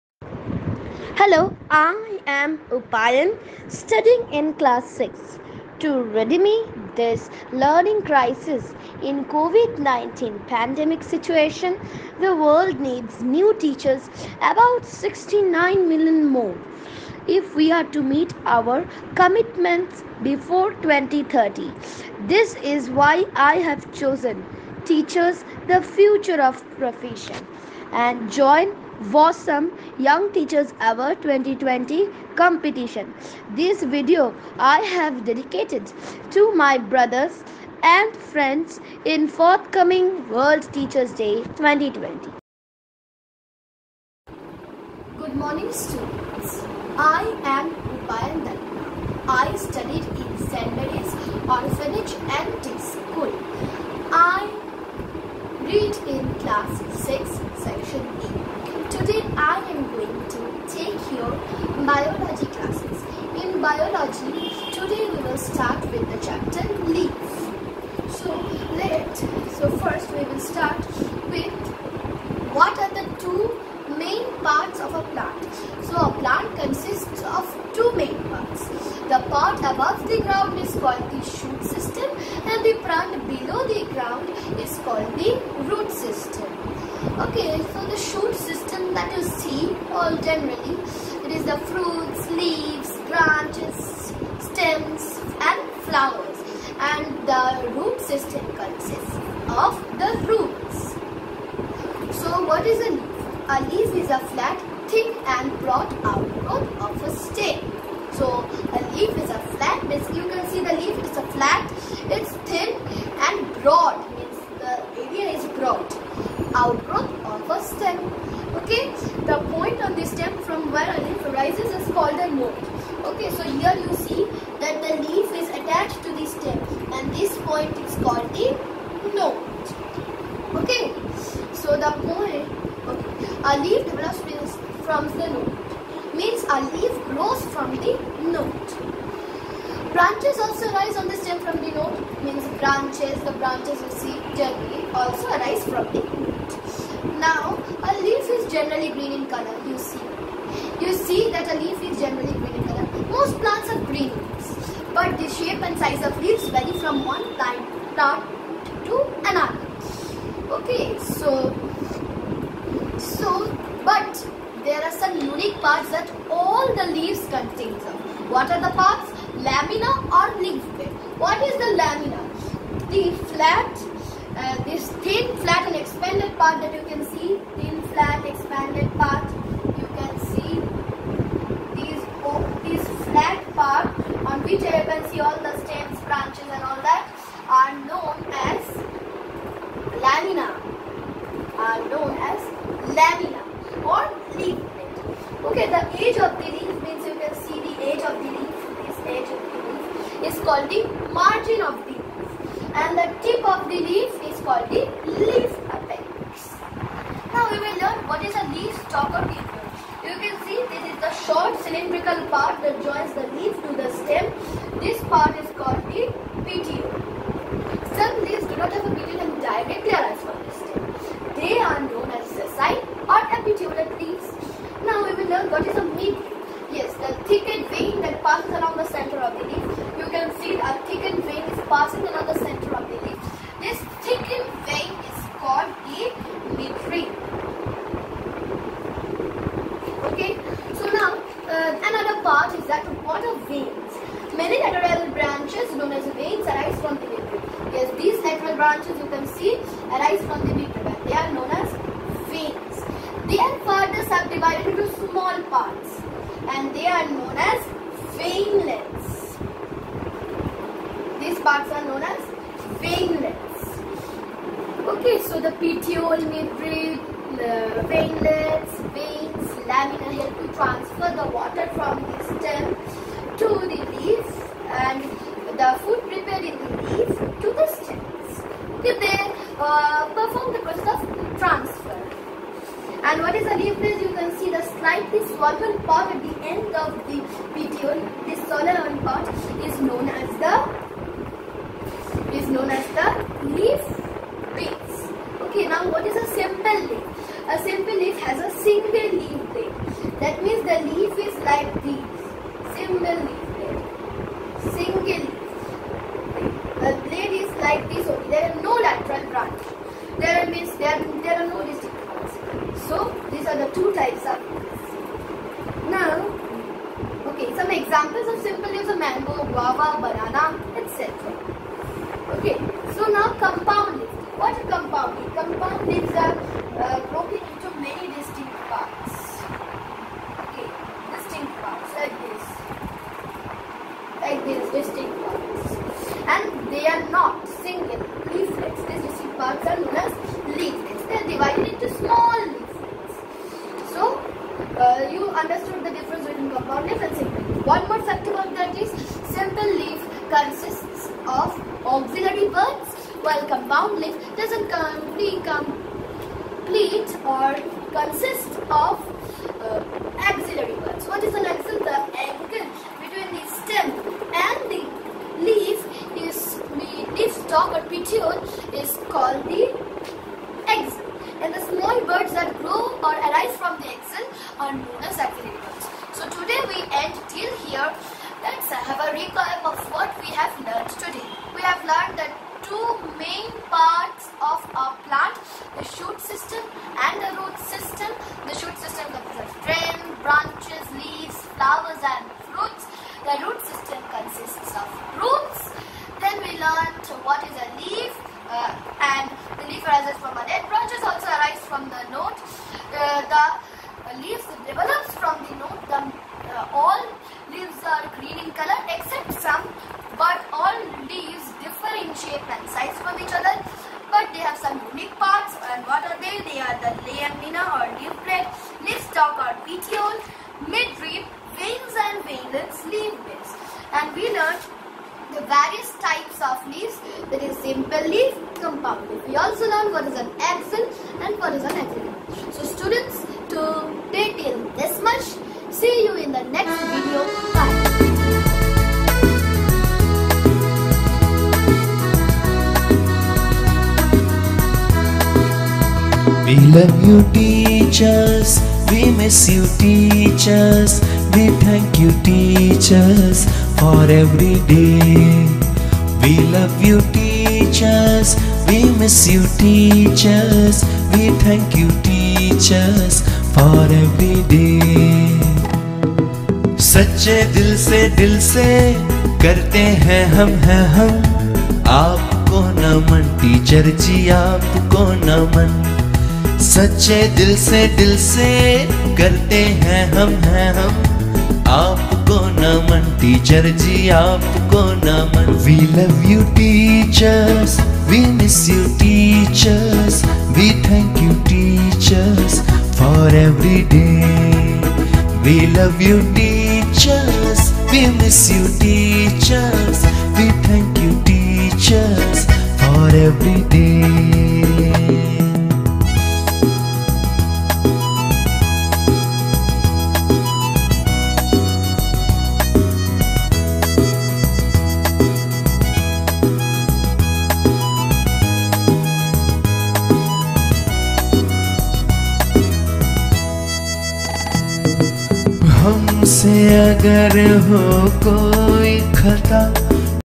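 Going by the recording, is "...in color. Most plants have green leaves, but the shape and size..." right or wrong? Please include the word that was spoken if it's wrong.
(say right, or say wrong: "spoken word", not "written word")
right.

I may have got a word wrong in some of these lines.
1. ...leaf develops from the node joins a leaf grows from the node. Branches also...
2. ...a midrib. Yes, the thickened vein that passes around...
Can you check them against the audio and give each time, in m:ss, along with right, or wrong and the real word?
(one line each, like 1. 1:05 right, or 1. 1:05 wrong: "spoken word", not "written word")
1. 2:13 wrong: "means", not "joins"
2. 3:45 right.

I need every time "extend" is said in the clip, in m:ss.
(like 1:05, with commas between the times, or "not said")
not said.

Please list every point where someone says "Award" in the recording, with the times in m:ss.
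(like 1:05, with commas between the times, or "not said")
0:30.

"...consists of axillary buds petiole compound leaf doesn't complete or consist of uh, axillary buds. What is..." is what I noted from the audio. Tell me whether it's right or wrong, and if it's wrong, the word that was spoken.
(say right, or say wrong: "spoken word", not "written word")
wrong: "while", not "petiole".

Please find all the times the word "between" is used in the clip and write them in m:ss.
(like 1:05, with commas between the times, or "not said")
5:46, 6:02.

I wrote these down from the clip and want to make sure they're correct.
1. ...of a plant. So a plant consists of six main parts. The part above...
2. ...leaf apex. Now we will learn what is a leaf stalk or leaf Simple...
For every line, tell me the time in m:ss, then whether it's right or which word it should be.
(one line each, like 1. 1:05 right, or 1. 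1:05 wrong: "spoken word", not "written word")
1. 1:14 wrong: "two", not "six"
2. 3:25 wrong: "You", not "Simple".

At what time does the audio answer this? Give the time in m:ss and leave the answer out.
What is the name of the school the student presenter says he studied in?
0:50.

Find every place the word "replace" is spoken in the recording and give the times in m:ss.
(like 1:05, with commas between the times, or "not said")
4:43.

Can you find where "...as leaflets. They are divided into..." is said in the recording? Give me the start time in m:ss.
5:39.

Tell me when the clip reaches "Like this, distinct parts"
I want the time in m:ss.
5:34.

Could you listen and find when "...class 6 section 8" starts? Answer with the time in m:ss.
0:56.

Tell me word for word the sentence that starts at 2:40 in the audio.
Okay, so, so, but there are some unique parts that all the leaves contain of.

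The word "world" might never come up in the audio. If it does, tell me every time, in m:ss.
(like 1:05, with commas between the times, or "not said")
0:12, 0:40.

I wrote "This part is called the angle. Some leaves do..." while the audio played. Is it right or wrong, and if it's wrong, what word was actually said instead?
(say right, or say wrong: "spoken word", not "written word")
wrong: "petiole", not "angle".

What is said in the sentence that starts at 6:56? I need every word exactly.
They are the lamina or leaflet, stalk or petiole, midrib, veins and veinlets, leaf base.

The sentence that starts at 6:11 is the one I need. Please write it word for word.
And the small buds that grow or arise from the axil are known as axillary so today we end till here.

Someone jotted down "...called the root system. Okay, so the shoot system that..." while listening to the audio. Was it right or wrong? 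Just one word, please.
right.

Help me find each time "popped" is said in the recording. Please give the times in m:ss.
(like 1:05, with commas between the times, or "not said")
not said.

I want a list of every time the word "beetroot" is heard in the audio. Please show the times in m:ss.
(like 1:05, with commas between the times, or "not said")
4:10.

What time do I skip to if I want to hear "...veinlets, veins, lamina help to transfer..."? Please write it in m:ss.
4:27.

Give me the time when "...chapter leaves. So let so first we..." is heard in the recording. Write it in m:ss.
1:06.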